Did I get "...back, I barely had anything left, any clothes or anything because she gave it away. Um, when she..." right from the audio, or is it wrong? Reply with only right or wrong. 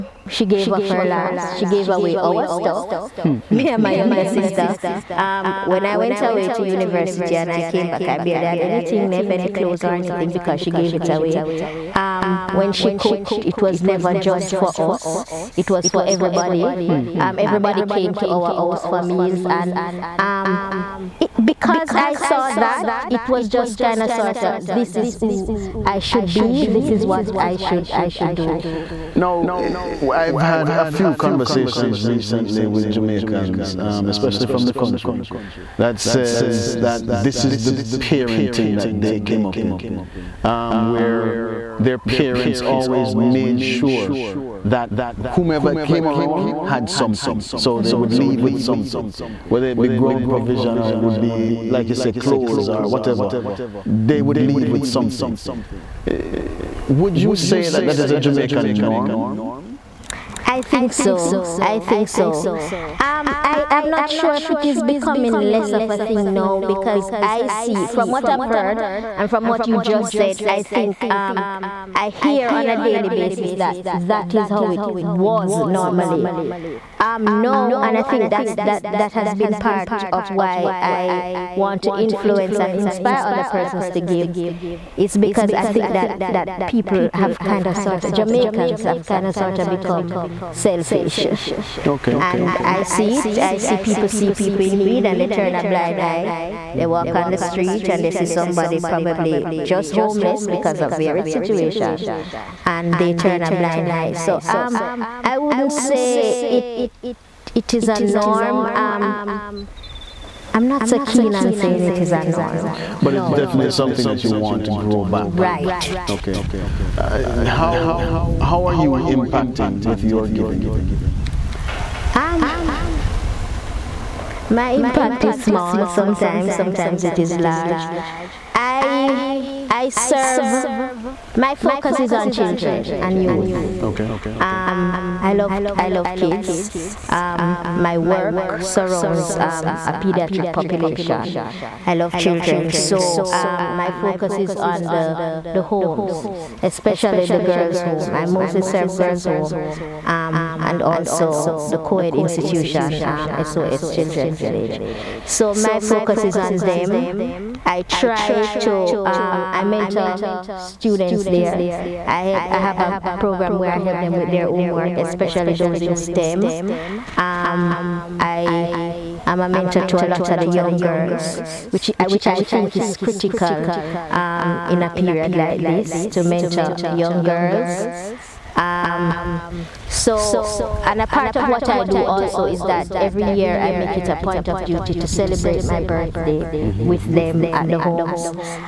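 right.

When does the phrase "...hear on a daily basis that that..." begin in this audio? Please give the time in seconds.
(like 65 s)
72 s.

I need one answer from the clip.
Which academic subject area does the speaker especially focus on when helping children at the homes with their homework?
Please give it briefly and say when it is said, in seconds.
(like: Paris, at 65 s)
STEM, at 165 s.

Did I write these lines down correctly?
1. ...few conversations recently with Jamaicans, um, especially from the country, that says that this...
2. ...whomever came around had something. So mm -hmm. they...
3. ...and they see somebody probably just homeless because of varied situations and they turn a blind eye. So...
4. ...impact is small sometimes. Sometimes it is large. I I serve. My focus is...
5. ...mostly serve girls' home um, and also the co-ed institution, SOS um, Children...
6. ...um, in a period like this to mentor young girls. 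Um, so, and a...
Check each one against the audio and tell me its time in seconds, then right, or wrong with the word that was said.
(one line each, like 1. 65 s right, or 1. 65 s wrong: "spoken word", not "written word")
1. 30 s right
2. 45 s right
3. 97 s right
4. 124 s right
5. 148 s right
6. 174 s right.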